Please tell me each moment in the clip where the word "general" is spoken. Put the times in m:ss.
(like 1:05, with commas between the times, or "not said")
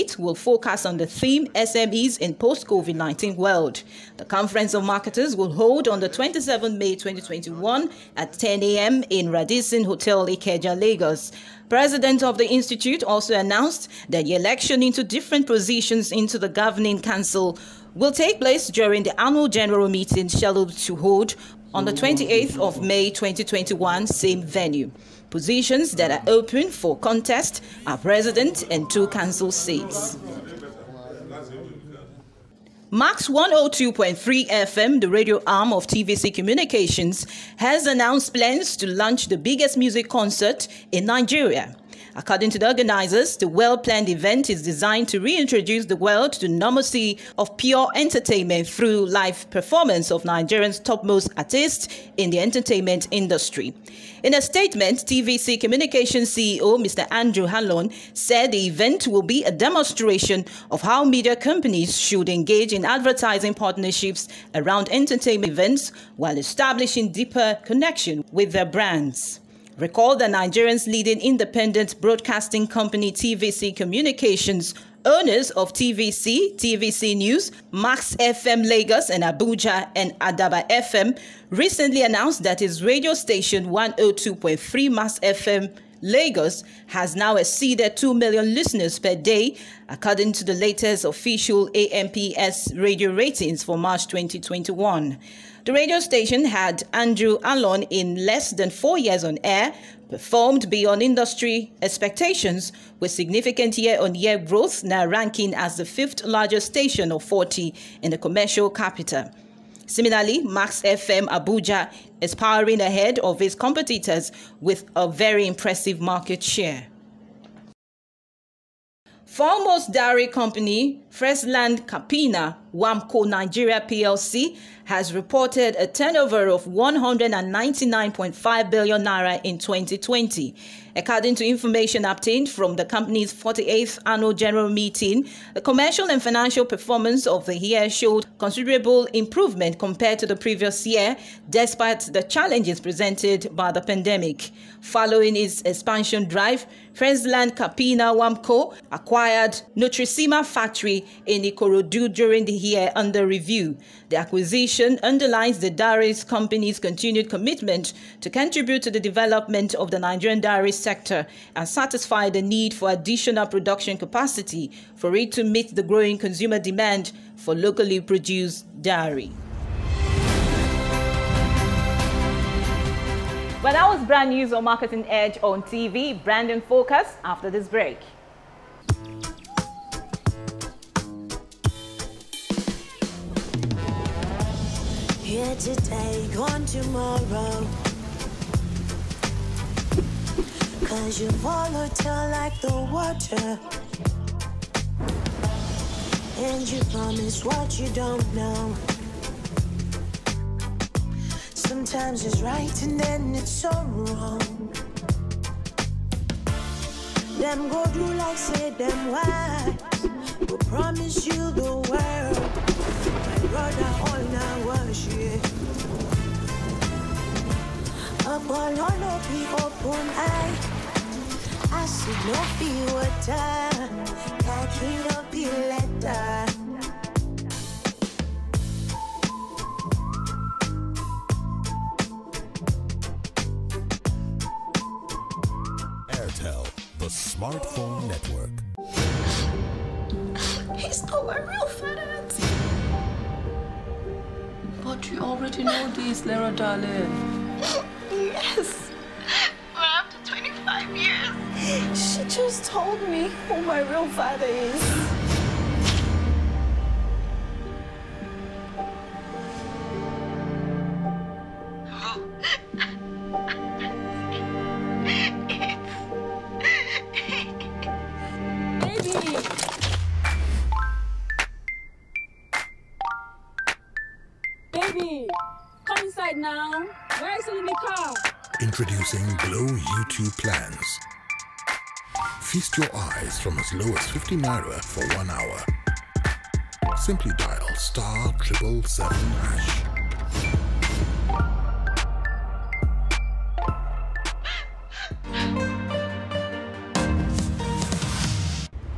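0:19, 2:14.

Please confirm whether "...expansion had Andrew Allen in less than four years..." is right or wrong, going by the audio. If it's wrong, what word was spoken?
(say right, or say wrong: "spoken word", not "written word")
wrong: "station", not "expansion".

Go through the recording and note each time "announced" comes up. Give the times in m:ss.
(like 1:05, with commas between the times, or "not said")
0:13, 0:37, 1:22.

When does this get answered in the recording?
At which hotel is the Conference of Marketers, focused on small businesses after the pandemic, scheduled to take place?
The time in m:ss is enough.
0:09.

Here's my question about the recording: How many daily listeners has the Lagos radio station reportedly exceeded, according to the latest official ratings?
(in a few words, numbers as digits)
2 million.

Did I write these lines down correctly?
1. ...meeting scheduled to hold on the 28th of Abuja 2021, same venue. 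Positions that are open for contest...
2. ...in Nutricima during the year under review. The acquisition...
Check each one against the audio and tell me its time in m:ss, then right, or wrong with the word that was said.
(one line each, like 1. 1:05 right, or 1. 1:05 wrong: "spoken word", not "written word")
1. 0:19 wrong: "May", not "Abuja"
2. 2:31 wrong: "Ikorodu", not "Nutricima".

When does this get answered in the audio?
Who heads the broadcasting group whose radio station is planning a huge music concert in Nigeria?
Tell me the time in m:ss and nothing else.
0:57.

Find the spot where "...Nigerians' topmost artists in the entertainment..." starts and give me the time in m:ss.
0:50.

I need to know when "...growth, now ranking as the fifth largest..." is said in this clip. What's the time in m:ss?
1:44.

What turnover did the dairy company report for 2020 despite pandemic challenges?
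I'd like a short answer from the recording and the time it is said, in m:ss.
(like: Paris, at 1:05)
199.5 billion naira, at 2:06.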